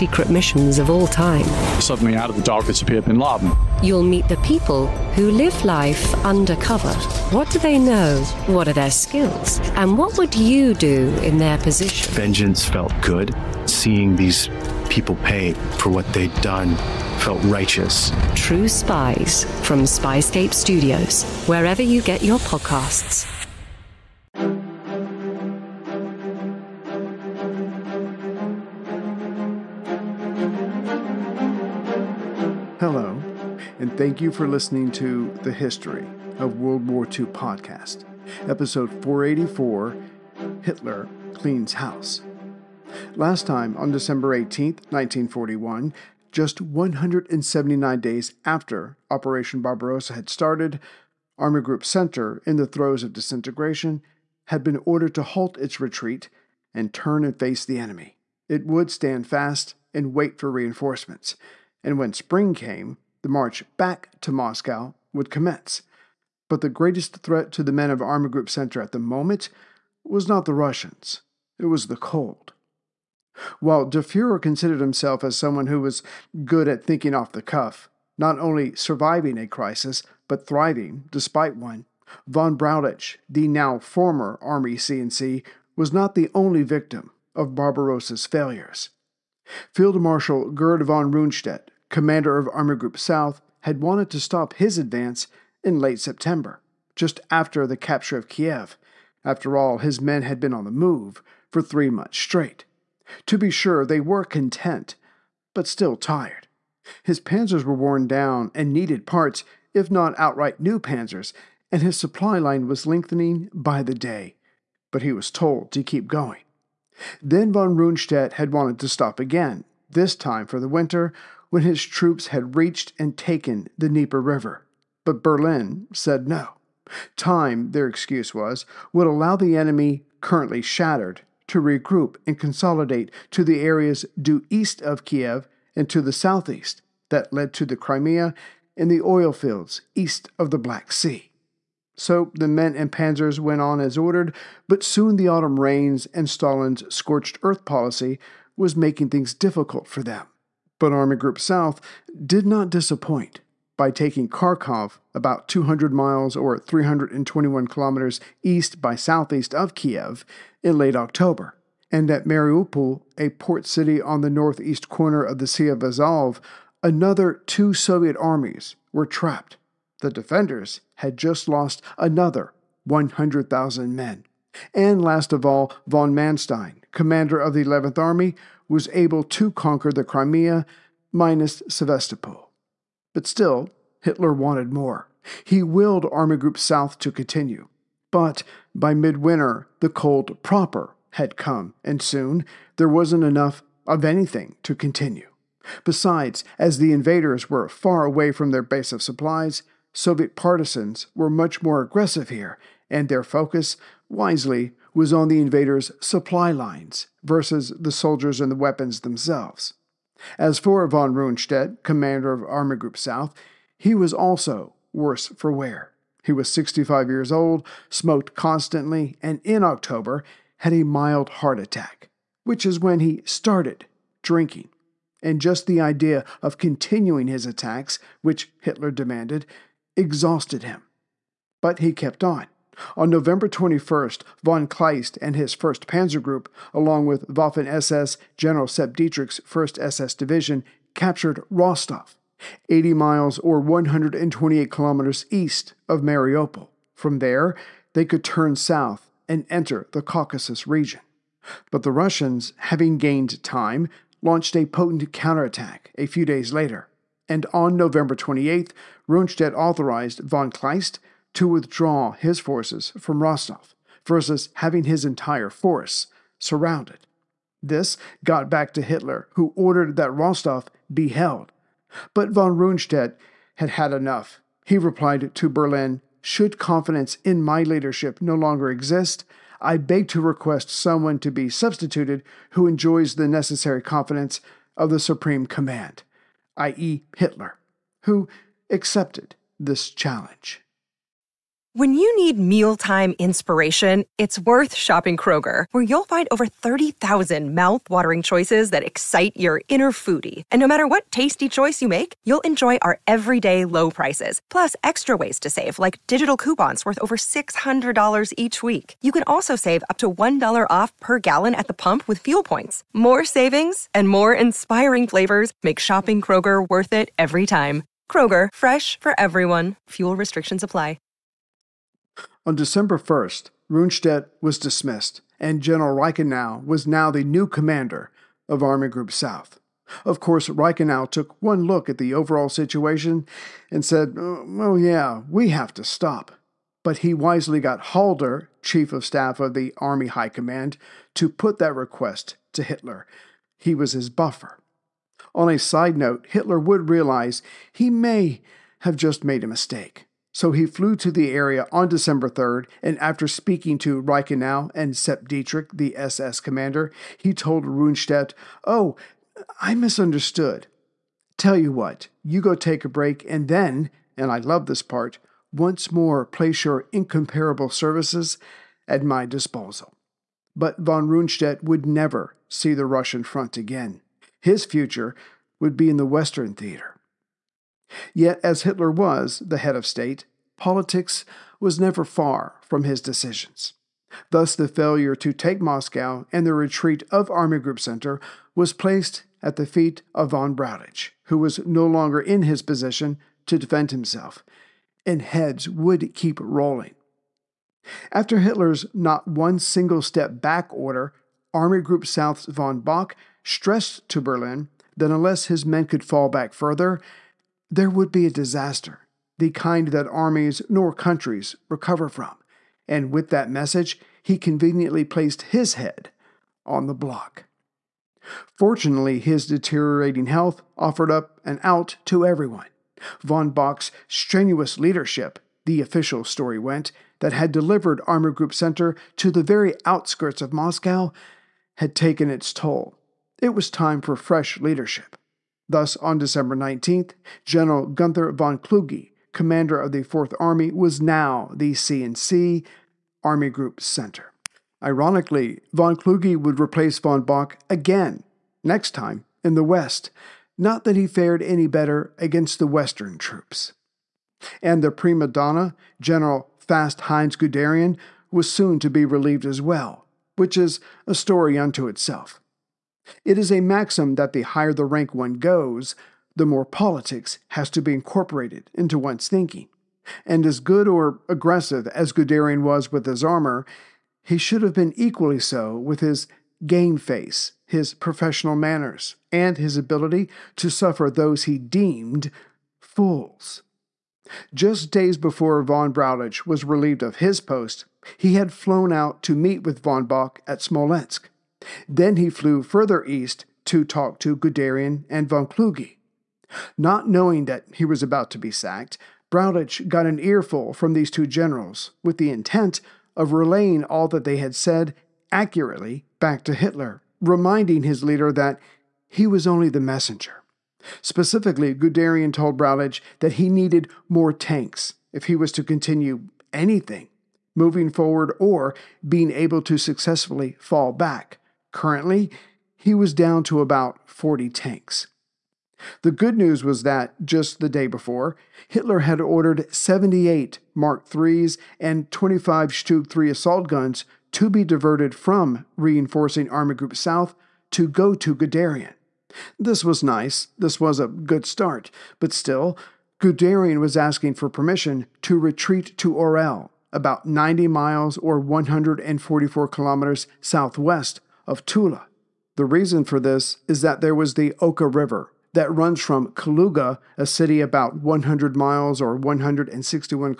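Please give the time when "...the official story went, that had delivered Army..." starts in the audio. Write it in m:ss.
7:05.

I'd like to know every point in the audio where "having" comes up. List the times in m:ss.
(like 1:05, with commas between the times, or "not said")
4:12, 4:24.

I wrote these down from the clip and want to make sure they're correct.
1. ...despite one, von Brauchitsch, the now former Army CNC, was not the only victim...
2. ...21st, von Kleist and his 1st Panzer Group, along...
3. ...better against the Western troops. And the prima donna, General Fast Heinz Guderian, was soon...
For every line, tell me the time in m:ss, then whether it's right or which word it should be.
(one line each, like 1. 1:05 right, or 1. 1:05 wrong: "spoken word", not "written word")
1. 1:21 right
2. 3:53 right
3. 7:31 right.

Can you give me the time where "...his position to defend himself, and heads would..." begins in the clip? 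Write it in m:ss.
6:32.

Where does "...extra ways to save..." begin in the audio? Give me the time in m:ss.
5:04.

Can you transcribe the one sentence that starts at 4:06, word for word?
From there, they could turn south and enter the Caucasus region.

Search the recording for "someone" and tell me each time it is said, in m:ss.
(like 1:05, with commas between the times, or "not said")
1:15, 4:40.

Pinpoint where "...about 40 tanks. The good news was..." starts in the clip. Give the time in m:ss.
8:43.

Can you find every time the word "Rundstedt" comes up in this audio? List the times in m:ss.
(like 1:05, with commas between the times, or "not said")
1:31, 1:57, 3:31, 4:19, 4:32, 5:23, 5:57, 6:11.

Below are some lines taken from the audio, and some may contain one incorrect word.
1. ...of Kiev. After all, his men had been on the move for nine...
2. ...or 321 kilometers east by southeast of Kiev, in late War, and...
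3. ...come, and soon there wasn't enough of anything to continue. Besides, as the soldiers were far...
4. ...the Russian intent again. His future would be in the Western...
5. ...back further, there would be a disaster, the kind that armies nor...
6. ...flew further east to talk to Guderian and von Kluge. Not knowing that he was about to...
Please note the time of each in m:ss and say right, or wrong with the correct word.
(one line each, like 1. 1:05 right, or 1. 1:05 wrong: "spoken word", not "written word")
1. 1:38 wrong: "three", not "nine"
2. 2:36 wrong: "October", not "War"
3. 3:11 wrong: "invaders", not "soldiers"
4. 6:12 wrong: "front", not "intent"
5. 6:46 right
6. 8:12 right.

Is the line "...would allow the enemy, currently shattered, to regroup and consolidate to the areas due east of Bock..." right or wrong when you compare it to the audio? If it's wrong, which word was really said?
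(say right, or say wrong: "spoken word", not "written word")
wrong: "Kiev", not "Bock".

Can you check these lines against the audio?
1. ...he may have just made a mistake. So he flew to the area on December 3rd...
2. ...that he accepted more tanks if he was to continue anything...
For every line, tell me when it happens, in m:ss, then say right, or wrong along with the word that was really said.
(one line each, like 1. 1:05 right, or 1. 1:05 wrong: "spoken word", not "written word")
1. 5:47 right
2. 8:33 wrong: "needed", not "accepted".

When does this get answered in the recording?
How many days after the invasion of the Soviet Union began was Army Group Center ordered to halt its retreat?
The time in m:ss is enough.
0:46.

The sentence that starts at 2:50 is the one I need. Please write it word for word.
The defenders had just lost another 100,000 men.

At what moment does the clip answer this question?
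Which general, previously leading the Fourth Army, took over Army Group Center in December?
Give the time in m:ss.
7:17.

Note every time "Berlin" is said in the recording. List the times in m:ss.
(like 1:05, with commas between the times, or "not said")
2:05, 4:35, 6:44.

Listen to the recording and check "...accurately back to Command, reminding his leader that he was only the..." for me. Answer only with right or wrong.
wrong.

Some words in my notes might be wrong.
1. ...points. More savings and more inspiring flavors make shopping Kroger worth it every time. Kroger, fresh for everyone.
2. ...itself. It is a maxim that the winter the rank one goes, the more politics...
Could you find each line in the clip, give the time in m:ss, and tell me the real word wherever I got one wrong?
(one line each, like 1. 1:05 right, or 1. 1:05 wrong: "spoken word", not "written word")
1. 5:12 right
2. 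7:41 wrong: "higher", not "winter".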